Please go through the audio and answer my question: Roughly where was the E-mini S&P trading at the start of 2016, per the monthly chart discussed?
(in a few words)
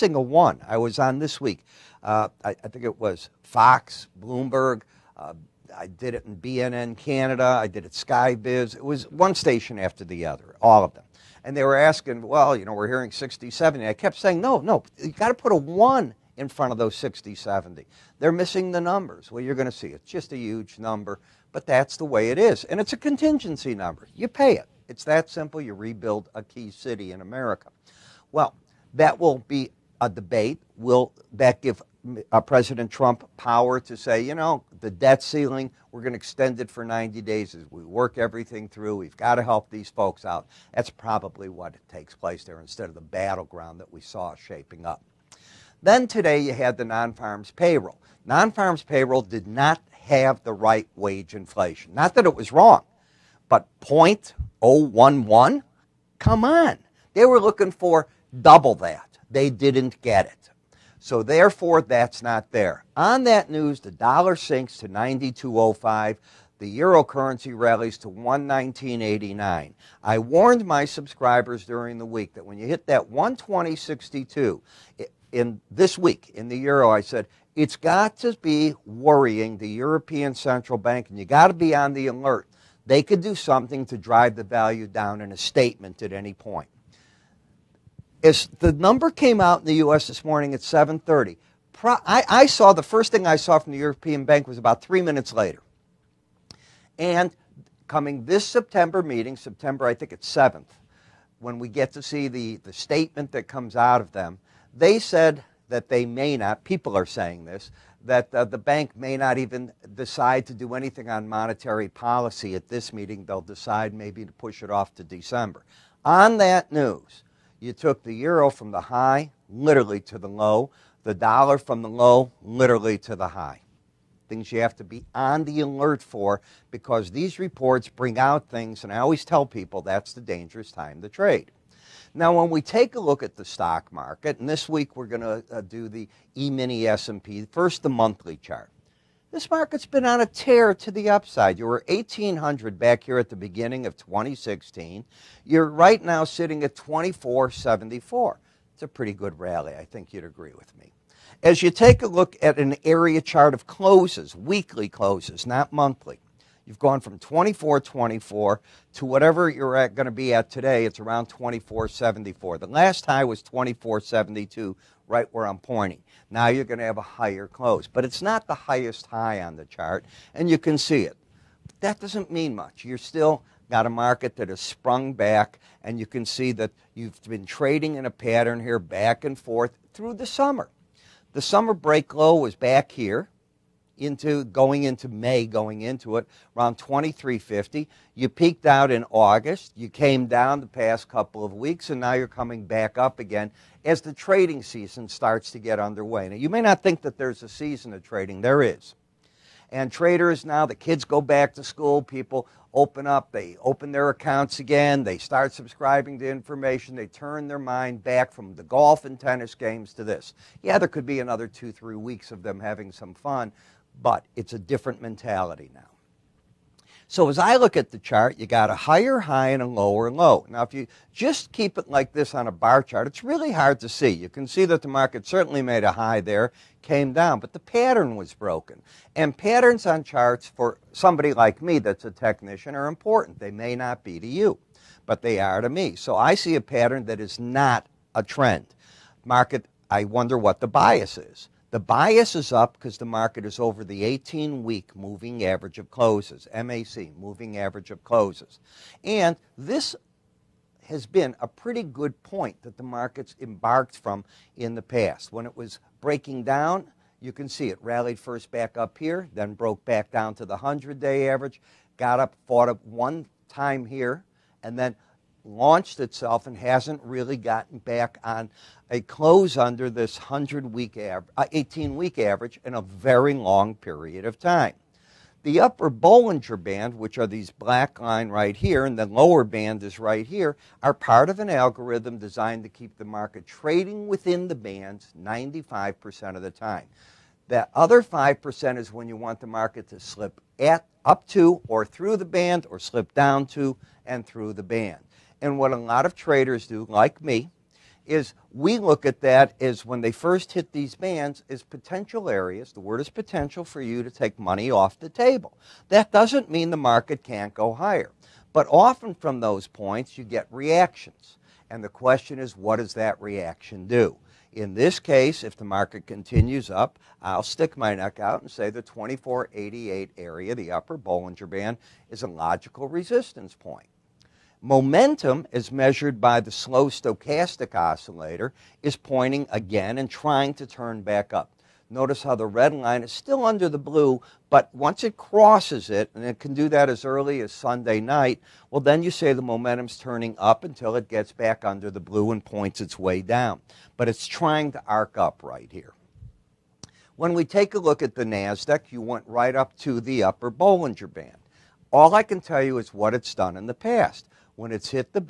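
1800.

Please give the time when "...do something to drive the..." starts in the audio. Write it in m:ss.
1:23.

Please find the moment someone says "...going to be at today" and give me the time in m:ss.
2:39.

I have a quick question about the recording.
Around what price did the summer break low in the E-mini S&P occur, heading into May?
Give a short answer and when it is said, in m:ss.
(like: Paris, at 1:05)
2350, at 3:06.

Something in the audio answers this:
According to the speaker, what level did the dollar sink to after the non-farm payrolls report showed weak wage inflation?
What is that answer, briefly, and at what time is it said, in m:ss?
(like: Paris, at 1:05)
92.05, at 1:04.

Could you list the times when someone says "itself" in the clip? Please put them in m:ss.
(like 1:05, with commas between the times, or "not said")
4:25.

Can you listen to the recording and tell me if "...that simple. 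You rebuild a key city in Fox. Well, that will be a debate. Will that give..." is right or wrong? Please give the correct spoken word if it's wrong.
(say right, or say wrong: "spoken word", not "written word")
wrong: "America", not "Fox".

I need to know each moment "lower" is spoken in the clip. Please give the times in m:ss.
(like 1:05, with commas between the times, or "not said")
3:39, 4:39.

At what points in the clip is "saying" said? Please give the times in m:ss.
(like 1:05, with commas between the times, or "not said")
0:14, 1:47.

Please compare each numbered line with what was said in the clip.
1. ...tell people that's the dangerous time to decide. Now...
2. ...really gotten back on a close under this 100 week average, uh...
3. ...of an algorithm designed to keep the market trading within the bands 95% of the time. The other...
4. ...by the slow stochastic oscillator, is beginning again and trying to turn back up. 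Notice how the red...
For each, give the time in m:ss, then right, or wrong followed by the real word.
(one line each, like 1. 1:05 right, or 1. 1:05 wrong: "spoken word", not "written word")
1. 2:09 wrong: "trade", not "decide"
2. 4:27 right
3. 4:41 right
4. 5:26 wrong: "pointing", not "beginning".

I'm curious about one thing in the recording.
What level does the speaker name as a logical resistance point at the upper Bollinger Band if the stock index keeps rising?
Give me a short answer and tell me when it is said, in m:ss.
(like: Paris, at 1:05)
2488, at 5:18.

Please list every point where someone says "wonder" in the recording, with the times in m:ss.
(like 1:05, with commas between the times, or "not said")
4:00.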